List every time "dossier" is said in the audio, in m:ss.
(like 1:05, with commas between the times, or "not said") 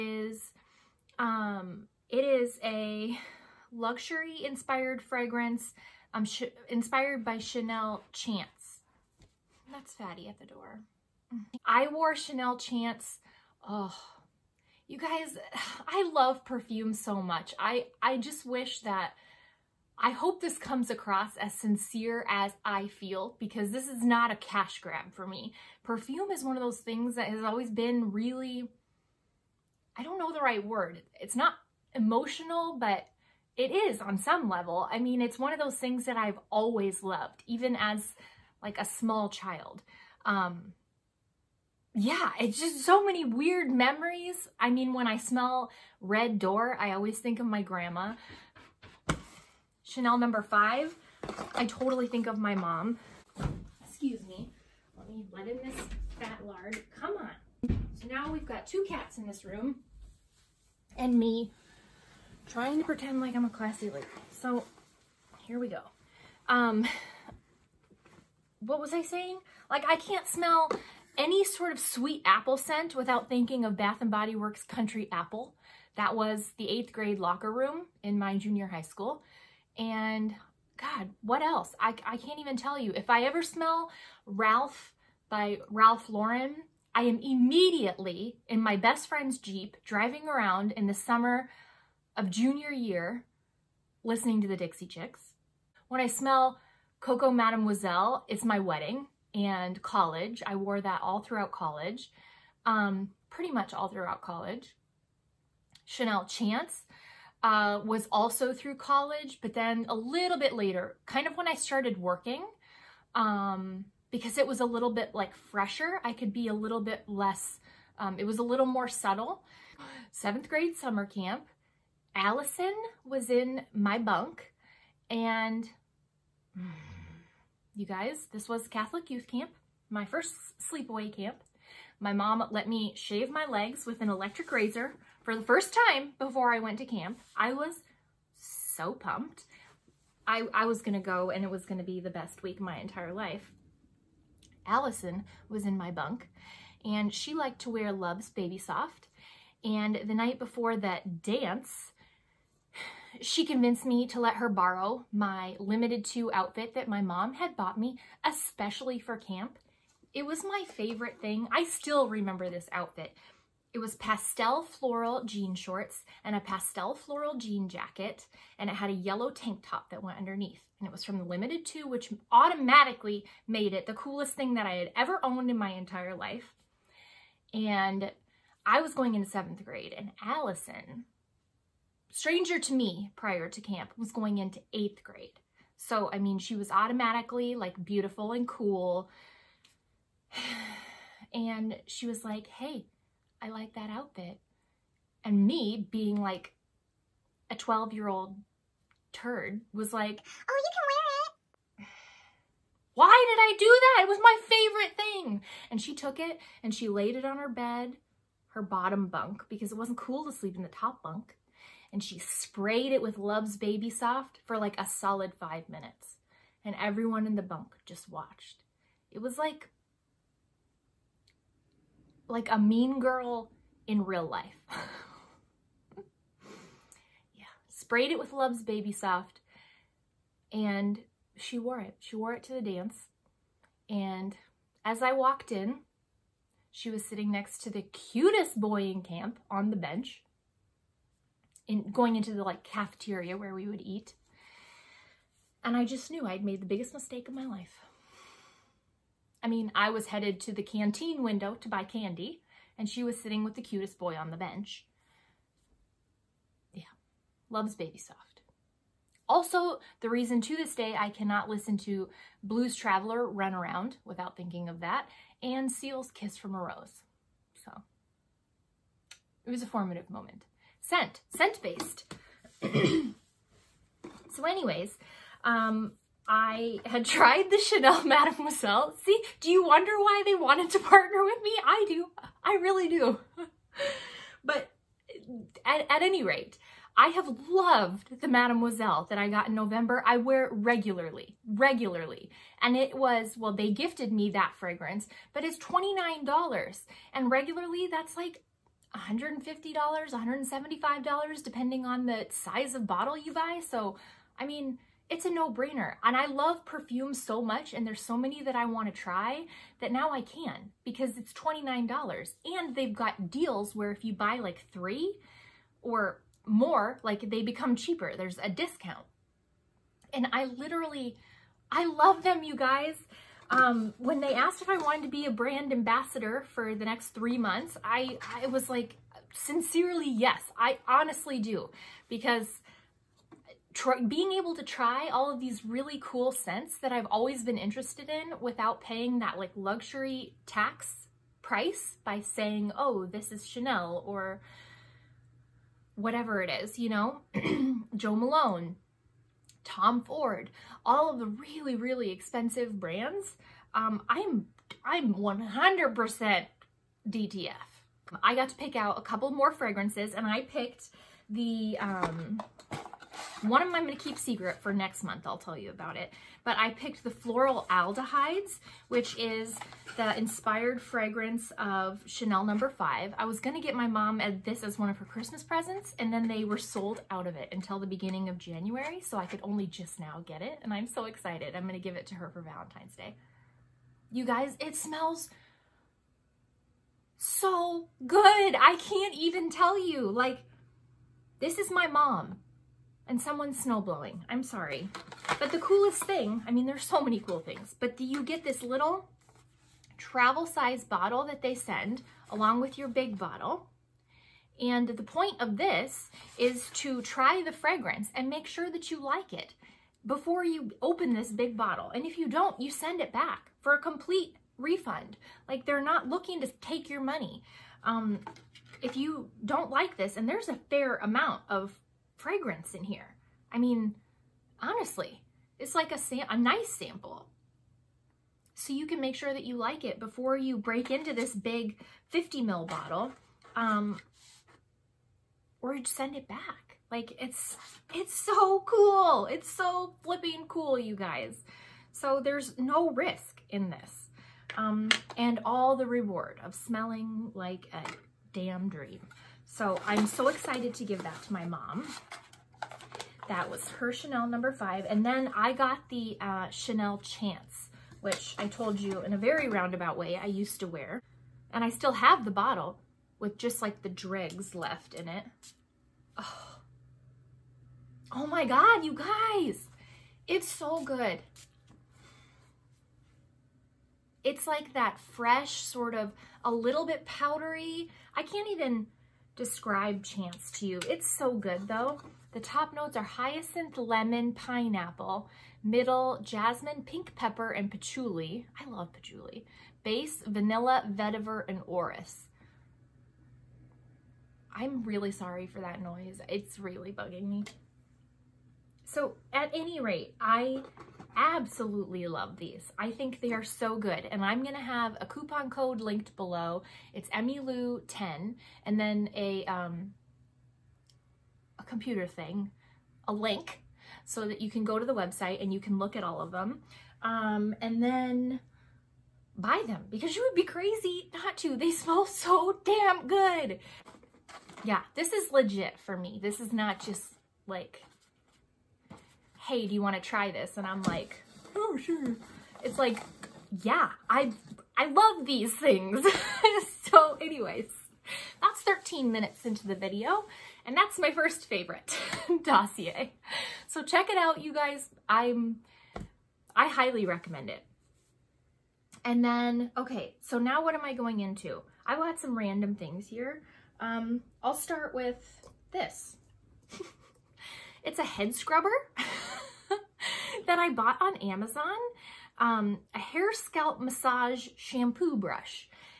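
9:02.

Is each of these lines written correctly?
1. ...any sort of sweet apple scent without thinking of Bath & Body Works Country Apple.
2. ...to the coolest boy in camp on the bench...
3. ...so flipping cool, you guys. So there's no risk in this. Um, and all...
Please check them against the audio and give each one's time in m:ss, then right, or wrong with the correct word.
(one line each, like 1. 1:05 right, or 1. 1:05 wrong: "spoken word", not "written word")
1. 1:11 right
2. 3:57 wrong: "cutest", not "coolest"
3. 7:19 right.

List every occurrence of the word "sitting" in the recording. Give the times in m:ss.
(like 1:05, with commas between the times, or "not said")
3:57, 4:13.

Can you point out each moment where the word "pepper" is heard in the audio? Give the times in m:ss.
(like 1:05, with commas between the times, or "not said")
8:07.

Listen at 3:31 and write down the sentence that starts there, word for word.
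And she sprayed it with Love's Baby Soft for like a solid five minutes.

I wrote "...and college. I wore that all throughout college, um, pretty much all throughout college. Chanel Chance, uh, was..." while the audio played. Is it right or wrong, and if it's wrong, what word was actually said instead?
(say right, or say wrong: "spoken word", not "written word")
right.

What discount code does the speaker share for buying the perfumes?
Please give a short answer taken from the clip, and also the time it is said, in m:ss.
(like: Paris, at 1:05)
EmiLou10, at 8:27.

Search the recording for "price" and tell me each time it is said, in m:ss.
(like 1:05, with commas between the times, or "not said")
5:41.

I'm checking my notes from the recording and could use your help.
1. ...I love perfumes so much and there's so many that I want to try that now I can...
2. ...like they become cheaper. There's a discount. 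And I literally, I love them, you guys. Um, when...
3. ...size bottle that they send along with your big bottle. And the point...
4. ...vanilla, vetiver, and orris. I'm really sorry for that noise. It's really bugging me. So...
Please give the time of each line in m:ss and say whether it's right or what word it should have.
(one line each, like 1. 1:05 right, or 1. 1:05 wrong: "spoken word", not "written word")
1. 5:06 right
2. 5:17 right
3. 6:40 right
4. 8:10 right.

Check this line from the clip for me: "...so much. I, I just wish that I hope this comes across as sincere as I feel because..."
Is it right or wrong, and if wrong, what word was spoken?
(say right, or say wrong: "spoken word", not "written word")
right.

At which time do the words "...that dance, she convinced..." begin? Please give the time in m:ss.
2:30.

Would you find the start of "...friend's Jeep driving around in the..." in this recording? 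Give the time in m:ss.
1:29.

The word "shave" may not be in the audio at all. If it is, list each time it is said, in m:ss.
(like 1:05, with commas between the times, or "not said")
2:12.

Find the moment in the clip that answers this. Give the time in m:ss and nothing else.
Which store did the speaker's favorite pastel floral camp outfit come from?
2:51.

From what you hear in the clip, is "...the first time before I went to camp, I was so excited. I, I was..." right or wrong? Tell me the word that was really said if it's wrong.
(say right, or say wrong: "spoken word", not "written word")
wrong: "pumped", not "excited".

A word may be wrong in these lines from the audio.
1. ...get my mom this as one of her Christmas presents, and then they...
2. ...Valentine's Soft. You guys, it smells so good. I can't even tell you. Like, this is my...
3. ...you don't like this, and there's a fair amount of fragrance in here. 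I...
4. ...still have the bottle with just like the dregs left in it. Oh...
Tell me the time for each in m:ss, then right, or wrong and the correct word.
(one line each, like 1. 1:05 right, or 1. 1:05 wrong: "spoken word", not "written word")
1. 6:13 right
2. 6:22 wrong: "Day", not "Soft"
3. 6:58 right
4. 7:41 right.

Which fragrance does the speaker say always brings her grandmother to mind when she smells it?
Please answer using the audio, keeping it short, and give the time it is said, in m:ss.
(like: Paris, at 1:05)
Red Door, at 0:46.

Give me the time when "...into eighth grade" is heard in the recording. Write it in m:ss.
3:04.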